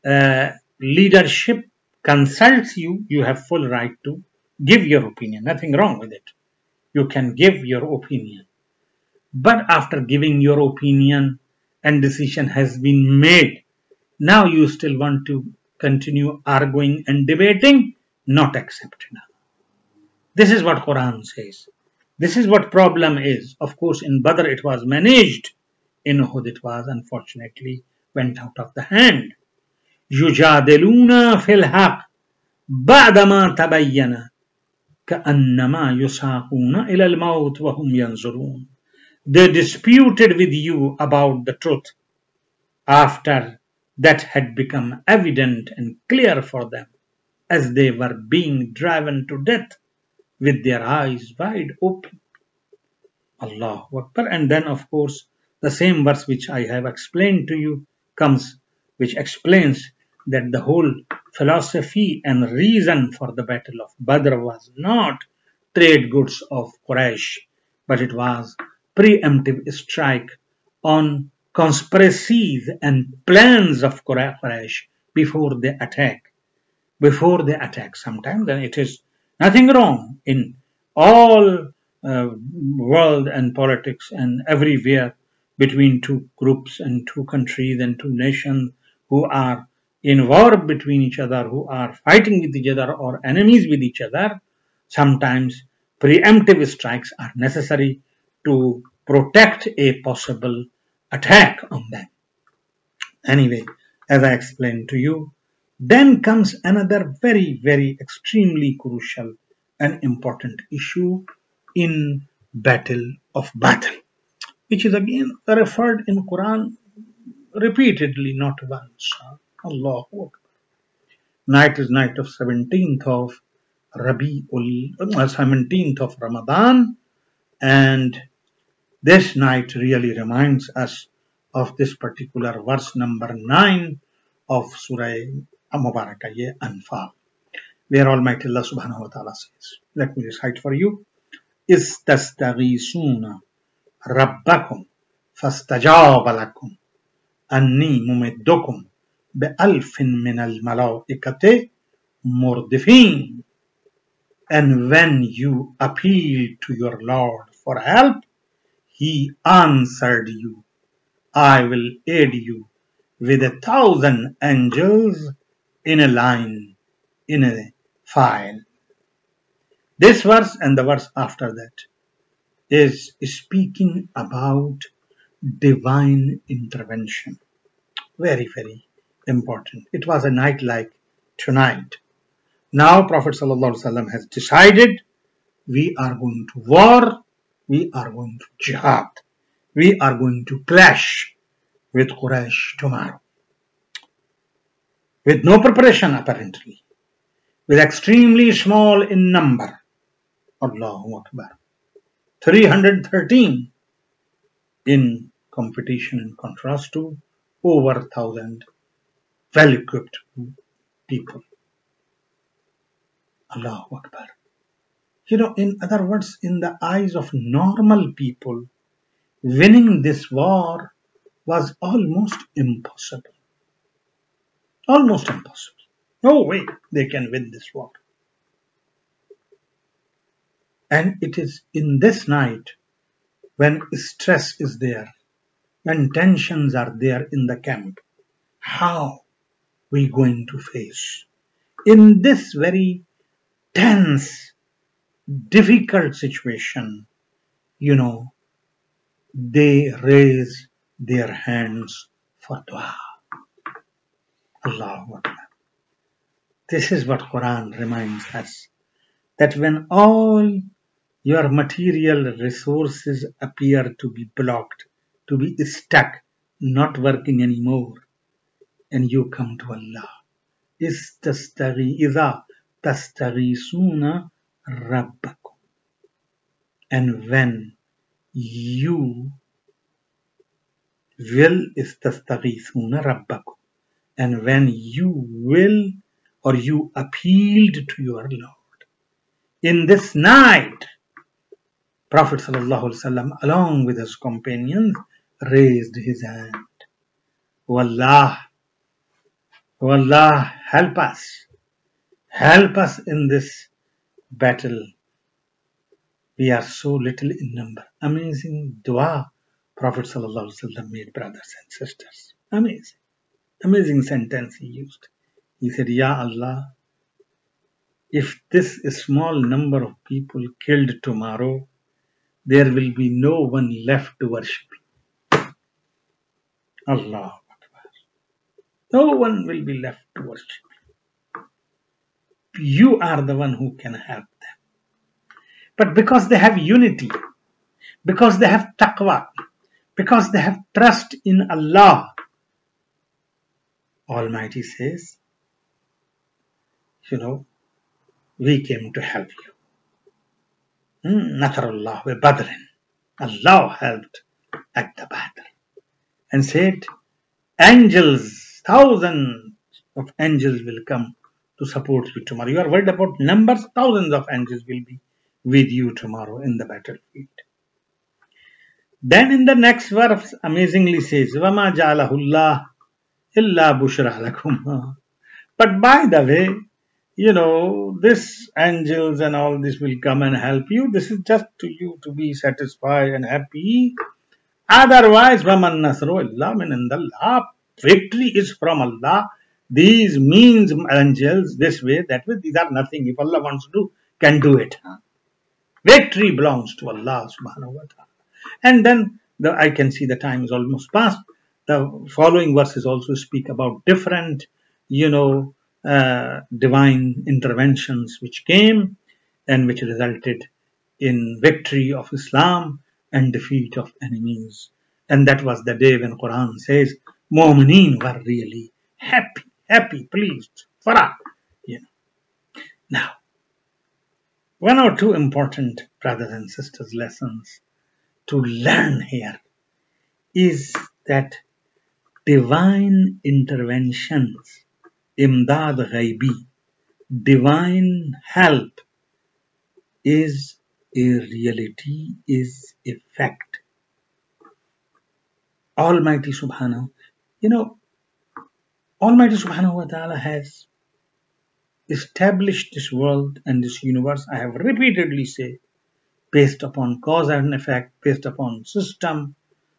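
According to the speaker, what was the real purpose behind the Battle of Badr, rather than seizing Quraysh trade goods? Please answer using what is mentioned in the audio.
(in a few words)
preemptive strike.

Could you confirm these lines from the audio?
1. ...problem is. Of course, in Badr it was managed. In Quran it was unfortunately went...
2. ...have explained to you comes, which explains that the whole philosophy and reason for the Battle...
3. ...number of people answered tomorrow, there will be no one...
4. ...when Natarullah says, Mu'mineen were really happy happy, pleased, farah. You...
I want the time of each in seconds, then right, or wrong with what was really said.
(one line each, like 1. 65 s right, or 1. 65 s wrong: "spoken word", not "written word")
1. 22 s wrong: "Uhud", not "Quran"
2. 56 s right
3. 319 s wrong: "killed", not "answered"
4. 415 s wrong: "Quran", not "Natarullah".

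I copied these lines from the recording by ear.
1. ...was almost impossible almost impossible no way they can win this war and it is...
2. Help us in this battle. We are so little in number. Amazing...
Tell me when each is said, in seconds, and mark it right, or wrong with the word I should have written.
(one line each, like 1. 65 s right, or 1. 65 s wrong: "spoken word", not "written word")
1. 221 s right
2. 302 s right.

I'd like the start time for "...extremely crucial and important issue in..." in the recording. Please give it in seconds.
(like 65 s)
108 s.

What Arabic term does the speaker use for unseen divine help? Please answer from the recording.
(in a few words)
imdad ghaibi.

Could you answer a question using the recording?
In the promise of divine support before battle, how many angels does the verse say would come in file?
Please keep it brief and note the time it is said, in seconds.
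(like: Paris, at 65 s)
a thousand, at 163 s.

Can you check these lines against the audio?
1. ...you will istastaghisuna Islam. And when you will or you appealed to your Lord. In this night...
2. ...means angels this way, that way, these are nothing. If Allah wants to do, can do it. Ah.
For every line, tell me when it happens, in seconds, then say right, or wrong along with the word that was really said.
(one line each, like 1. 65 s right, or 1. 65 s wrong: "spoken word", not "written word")
1. 278 s wrong: "Rabbakum", not "Islam"
2. 390 s right.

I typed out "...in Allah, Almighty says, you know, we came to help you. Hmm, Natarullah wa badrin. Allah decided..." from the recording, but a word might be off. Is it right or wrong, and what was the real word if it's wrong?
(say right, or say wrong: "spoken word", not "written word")
wrong: "helped", not "decided".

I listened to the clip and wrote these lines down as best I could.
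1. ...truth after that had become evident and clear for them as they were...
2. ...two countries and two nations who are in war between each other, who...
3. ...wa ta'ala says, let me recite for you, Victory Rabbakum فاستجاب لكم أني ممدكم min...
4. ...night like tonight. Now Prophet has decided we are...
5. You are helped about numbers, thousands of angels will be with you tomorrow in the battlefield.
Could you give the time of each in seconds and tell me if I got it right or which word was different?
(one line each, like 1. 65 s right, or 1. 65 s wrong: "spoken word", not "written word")
1. 41 s right
2. 87 s right
3. 139 s wrong: "Istastaghisuna", not "Victory"
4. 180 s right
5. 362 s wrong: "worried", not "helped".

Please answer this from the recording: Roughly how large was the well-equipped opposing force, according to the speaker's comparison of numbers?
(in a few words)
over 1000.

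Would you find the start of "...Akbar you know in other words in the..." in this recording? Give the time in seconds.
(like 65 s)
213 s.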